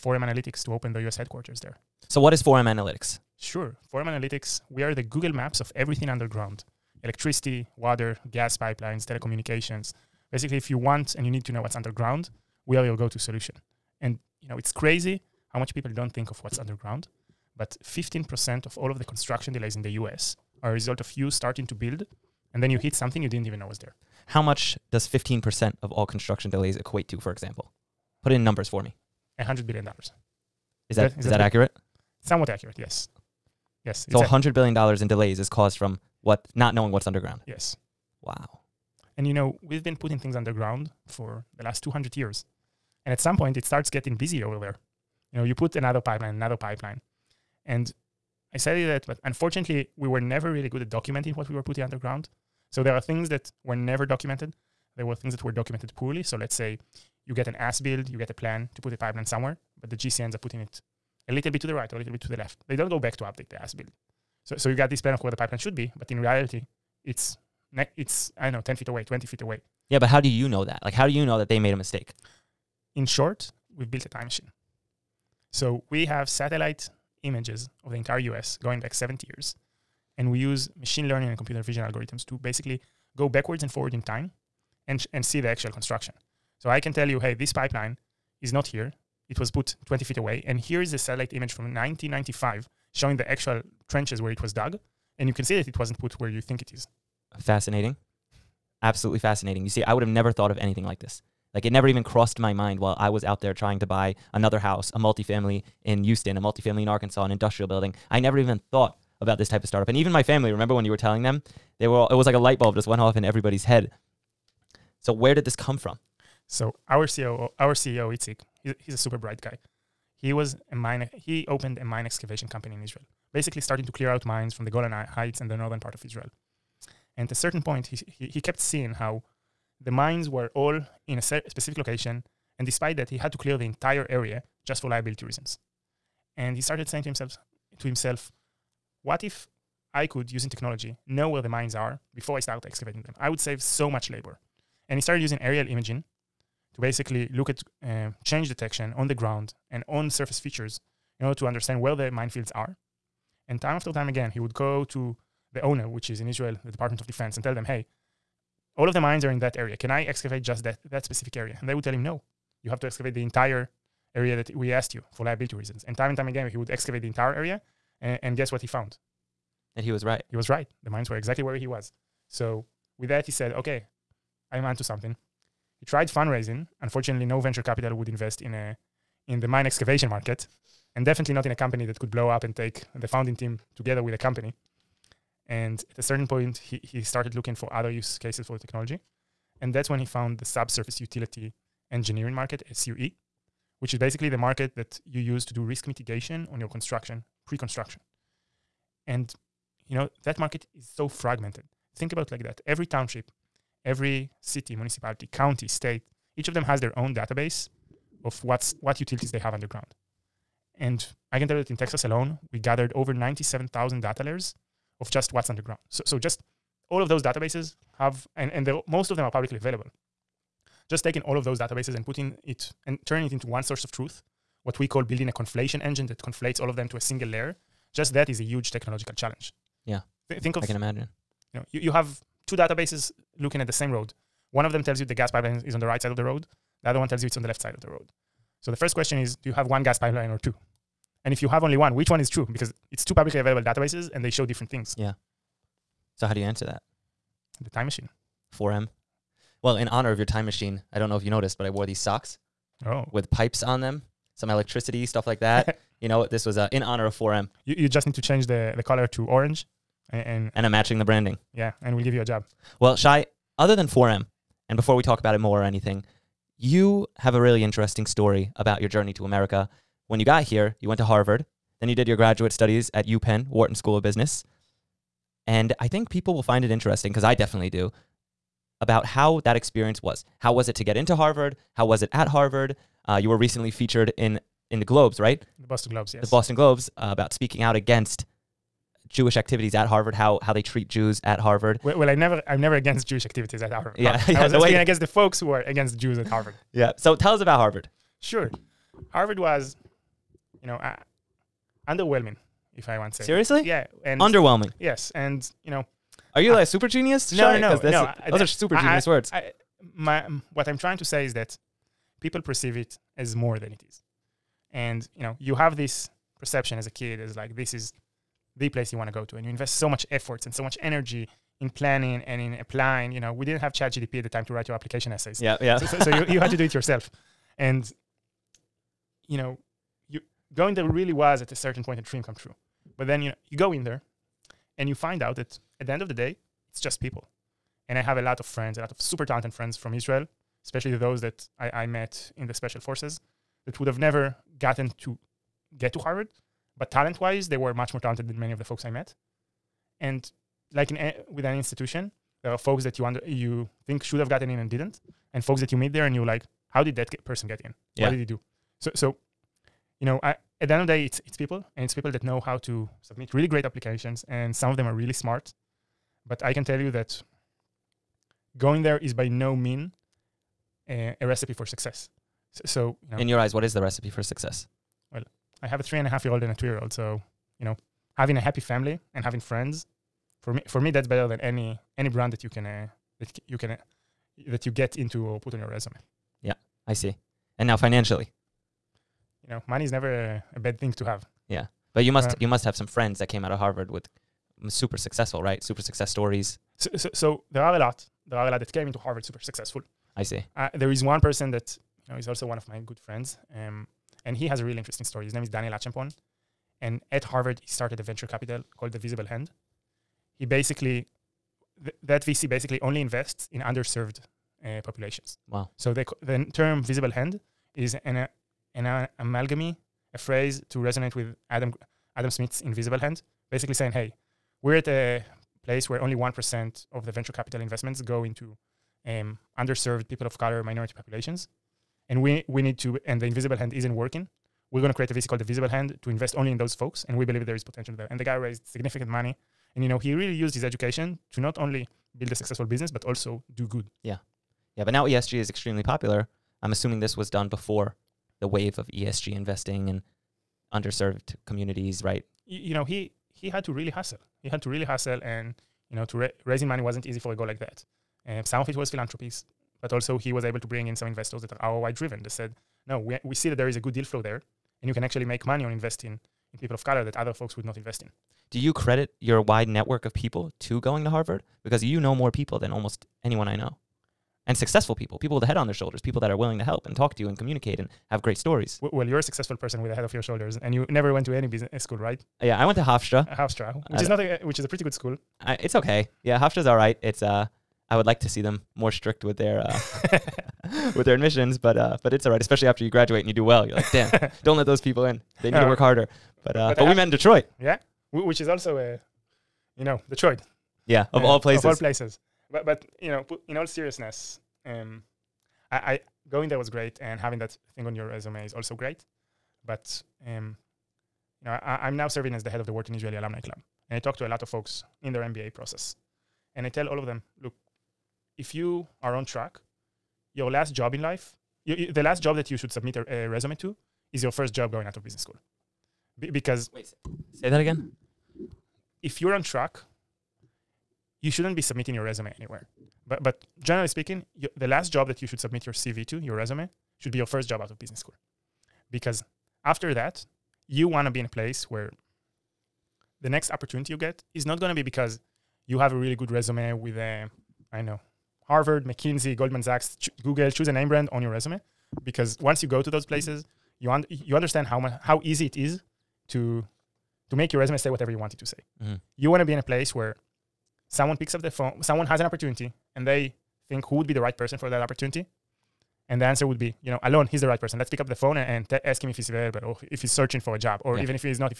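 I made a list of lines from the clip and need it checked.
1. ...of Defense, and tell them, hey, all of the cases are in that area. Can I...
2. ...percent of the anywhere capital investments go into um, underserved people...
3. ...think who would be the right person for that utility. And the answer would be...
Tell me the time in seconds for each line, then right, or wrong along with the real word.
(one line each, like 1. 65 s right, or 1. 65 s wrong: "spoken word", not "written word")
1. 156 s wrong: "mines", not "cases"
2. 426 s wrong: "venture", not "anywhere"
3. 563 s wrong: "opportunity", not "utility".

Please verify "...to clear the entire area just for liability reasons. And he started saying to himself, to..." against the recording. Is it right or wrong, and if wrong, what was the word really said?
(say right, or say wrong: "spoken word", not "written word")
right.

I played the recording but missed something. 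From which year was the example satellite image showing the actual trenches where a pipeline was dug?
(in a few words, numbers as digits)
1995.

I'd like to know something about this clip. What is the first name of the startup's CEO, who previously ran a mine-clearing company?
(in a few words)
Itzik.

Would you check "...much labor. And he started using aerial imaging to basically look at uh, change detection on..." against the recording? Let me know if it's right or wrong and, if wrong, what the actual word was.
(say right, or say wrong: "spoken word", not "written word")
right.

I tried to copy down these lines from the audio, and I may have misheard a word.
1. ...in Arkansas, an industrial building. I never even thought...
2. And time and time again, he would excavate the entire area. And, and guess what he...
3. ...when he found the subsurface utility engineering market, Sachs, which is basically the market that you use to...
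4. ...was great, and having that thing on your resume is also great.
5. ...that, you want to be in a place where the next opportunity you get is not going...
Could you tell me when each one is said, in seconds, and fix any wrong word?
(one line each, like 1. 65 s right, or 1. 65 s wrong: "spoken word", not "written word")
1. 106 s right
2. 165 s right
3. 189 s wrong: "SUE", not "Sachs"
4. 506 s right
5. 539 s right.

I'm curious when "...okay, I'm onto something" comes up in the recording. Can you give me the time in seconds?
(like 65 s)
173 s.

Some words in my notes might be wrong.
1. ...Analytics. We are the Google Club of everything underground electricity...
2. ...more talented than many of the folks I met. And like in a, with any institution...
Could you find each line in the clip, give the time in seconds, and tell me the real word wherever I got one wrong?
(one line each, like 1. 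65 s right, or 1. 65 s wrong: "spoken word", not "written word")
1. 4 s wrong: "Maps", not "Club"
2. 347 s right.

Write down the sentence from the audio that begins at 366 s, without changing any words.
But I can tell you that going there is by no means a, a recipe for success.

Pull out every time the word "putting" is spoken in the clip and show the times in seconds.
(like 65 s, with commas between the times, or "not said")
39 s, 51 s, 60 s, 222 s.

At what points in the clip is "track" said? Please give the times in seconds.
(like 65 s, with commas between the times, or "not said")
519 s, 529 s.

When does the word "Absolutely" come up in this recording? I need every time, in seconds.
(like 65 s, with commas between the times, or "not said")
98 s.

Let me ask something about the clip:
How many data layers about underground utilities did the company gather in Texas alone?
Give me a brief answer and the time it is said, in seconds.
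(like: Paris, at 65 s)
97,000, at 213 s.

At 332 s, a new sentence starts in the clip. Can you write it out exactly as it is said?
But then you know, you go in there and you find out that at the end of the day, it's just people.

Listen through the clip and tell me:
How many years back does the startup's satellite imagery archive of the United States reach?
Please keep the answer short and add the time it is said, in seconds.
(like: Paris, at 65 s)
70 years, at 78 s.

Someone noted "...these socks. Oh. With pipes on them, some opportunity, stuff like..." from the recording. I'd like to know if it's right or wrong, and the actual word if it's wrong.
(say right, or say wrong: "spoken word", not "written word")
wrong: "electricity", not "opportunity".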